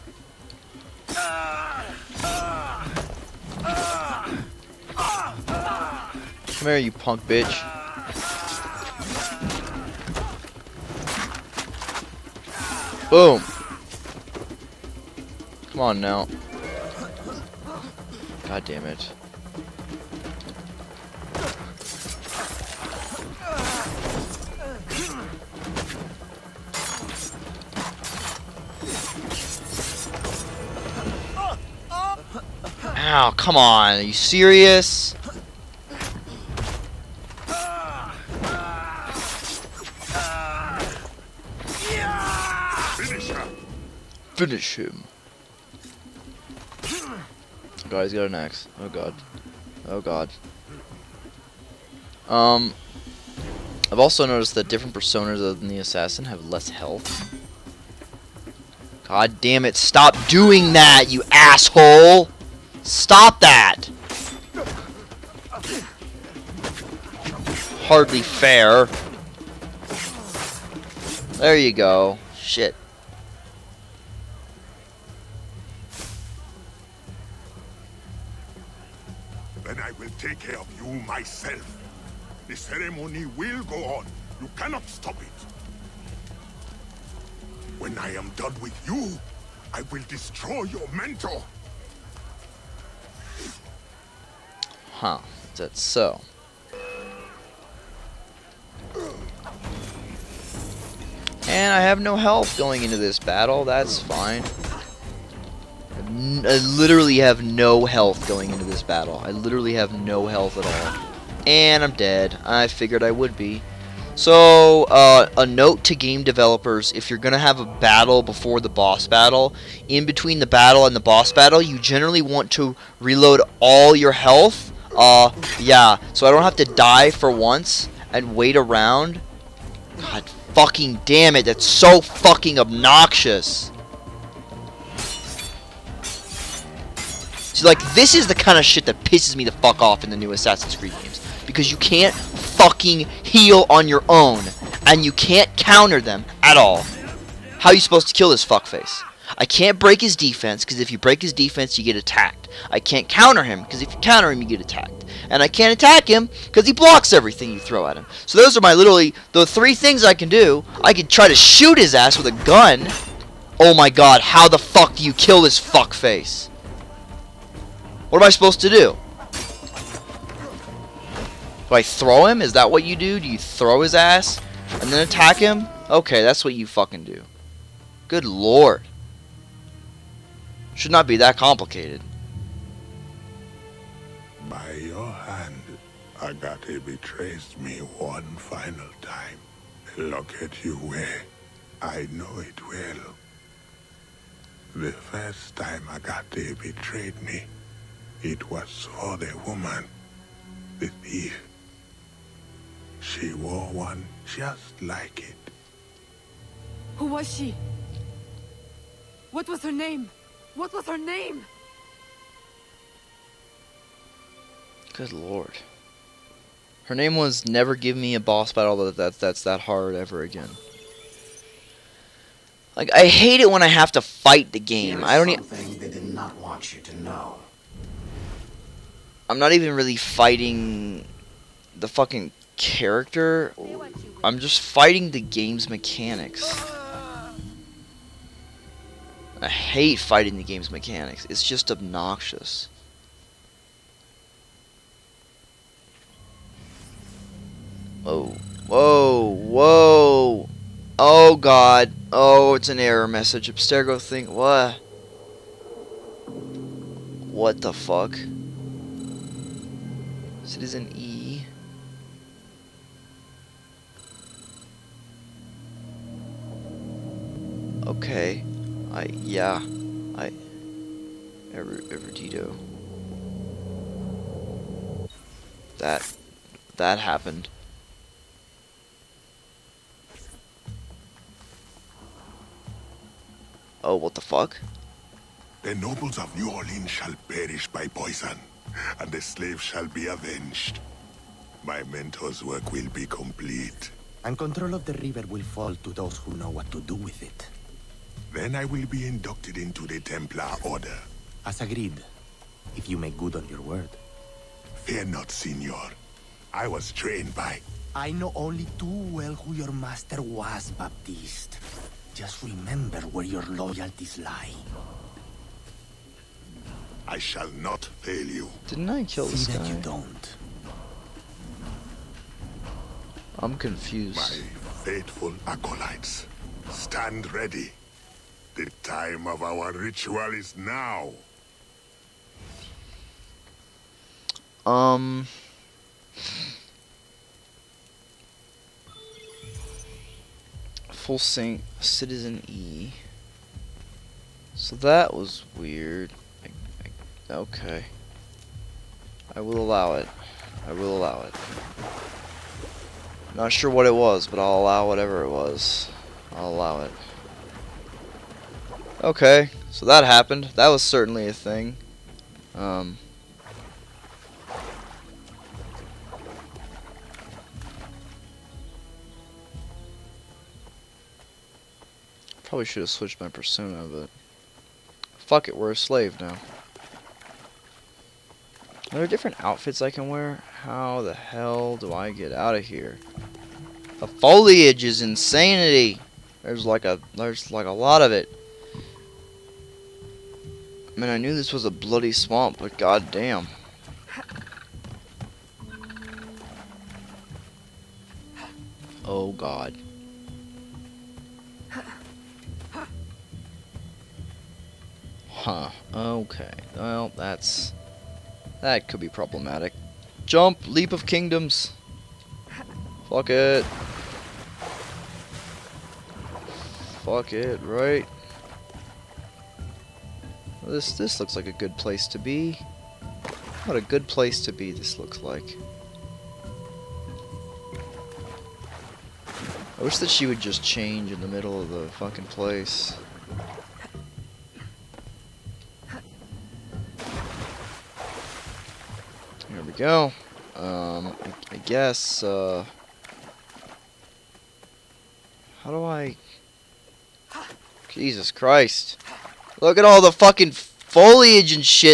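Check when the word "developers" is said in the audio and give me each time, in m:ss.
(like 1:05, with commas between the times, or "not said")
1:56.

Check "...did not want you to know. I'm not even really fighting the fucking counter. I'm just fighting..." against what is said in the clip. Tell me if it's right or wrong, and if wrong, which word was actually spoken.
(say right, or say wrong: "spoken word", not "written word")
wrong: "character", not "counter".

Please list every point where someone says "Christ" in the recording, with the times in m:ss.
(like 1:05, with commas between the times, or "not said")
7:28.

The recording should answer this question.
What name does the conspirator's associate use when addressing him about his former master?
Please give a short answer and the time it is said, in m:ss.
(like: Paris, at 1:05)
Baptiste, at 5:10.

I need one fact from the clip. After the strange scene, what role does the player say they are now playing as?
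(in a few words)
a slave.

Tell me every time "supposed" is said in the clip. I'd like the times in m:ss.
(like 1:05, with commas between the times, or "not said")
2:27, 2:48.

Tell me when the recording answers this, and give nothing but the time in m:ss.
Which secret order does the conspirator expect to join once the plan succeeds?
4:59.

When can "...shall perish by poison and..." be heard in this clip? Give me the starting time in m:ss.
4:46.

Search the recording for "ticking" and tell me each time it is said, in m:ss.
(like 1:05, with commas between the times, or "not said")
not said.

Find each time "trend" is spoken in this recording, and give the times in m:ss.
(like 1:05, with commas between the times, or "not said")
not said.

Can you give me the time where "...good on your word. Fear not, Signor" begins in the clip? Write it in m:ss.
5:03.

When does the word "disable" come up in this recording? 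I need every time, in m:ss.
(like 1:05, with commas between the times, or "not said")
not said.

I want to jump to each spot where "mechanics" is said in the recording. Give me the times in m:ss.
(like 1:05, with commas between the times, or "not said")
3:55, 4:00.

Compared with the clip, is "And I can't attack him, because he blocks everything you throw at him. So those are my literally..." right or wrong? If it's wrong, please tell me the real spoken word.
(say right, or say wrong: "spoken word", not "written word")
right.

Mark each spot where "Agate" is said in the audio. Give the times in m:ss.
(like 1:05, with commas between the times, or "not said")
3:06, 3:15.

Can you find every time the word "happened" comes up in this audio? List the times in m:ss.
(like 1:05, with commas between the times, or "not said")
4:36, 6:00.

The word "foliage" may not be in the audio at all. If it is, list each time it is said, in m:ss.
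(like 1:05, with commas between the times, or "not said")
6:24, 7:30.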